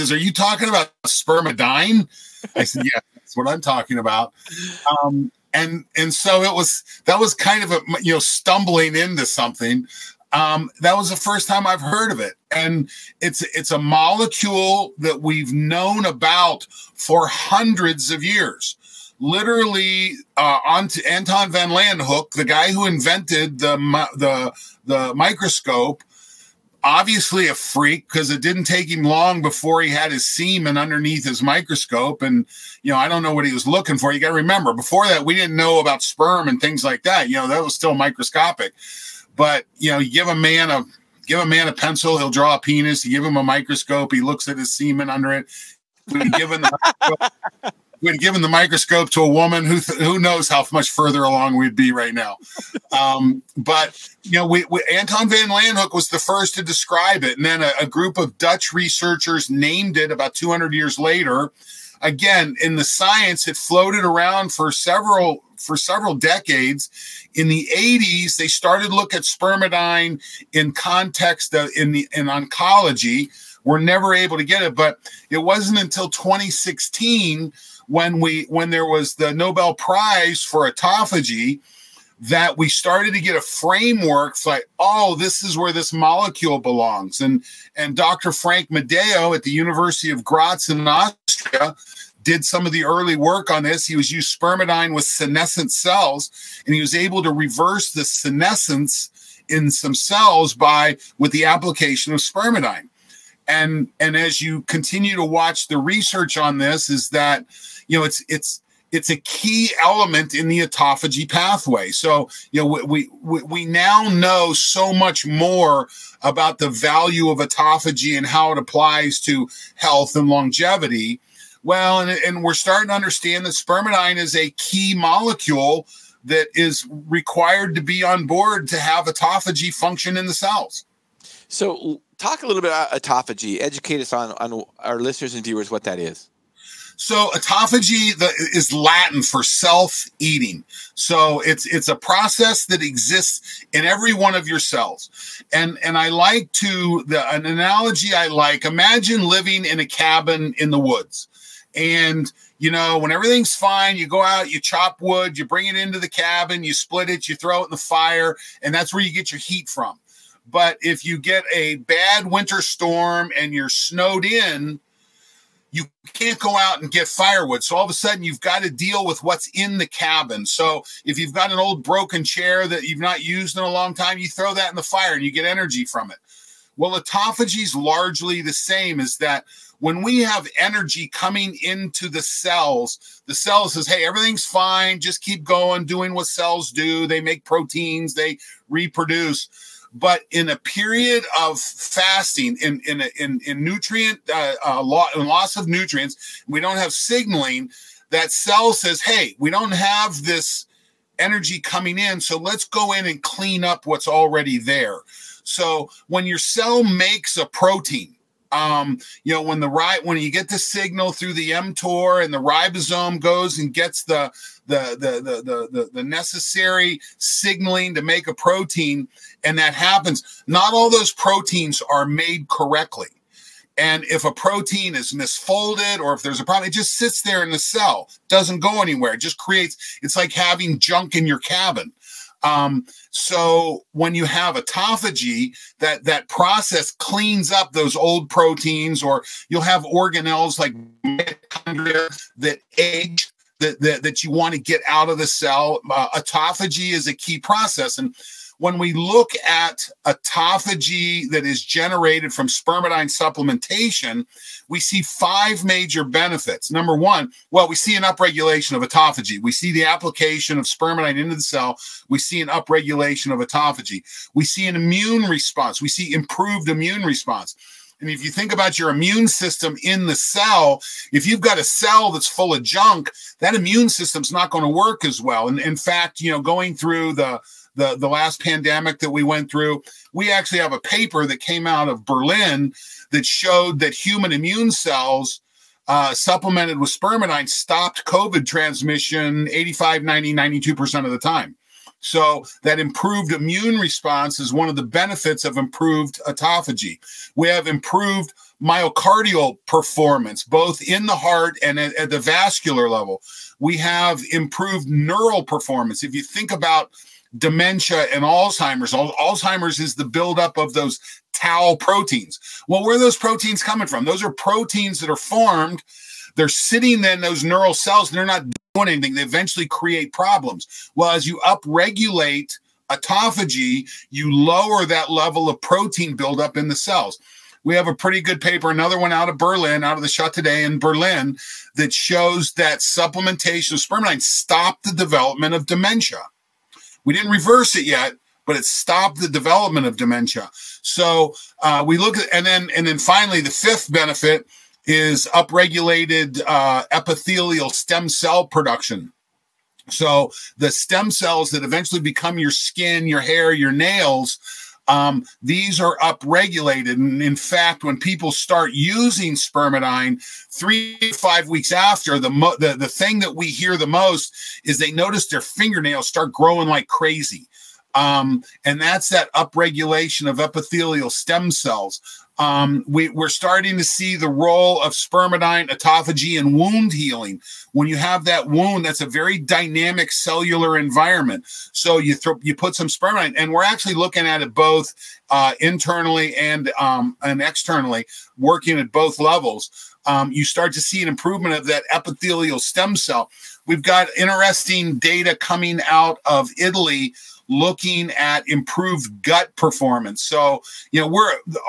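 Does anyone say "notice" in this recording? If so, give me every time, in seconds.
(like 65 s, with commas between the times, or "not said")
364 s.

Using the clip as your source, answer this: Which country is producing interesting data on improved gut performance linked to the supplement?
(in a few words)
Italy.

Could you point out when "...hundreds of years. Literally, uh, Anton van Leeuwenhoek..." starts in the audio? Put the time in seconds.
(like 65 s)
17 s.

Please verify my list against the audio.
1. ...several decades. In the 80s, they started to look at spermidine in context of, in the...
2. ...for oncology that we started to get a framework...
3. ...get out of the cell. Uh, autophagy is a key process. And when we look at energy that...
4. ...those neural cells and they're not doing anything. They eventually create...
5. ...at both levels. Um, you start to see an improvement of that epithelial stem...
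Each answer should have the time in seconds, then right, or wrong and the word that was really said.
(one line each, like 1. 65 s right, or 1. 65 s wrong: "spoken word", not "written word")
1. 65 s right
2. 80 s wrong: "autophagy", not "oncology"
3. 244 s wrong: "autophagy", not "energy"
4. 317 s right
5. 388 s right.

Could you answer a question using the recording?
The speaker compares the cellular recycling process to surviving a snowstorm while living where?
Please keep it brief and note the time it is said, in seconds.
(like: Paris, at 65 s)
A cabin in the woods, at 149 s.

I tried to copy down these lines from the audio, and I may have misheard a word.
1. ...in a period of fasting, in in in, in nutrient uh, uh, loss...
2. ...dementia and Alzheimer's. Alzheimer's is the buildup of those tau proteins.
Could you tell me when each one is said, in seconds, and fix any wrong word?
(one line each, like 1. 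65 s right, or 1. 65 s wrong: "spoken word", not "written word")
1. 190 s right
2. 307 s right.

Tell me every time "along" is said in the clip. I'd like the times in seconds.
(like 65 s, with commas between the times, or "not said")
51 s.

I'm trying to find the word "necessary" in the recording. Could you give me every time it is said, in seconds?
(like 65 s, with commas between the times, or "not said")
216 s.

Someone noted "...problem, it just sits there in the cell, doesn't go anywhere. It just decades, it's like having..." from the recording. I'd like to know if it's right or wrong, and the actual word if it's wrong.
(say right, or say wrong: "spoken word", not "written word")
wrong: "creates", not "decades".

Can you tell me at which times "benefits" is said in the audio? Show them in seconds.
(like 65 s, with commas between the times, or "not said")
256 s, 294 s, 343 s.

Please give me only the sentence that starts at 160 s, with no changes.
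But if you get a bad winter storm and you're snowed in, you can't go out and get firewood.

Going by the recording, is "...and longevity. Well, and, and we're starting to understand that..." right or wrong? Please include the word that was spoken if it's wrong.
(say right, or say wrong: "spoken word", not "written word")
right.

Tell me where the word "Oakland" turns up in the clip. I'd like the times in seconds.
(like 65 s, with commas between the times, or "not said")
not said.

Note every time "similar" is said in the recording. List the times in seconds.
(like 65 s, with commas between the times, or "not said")
not said.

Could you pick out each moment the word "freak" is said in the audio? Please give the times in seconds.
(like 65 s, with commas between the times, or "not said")
27 s.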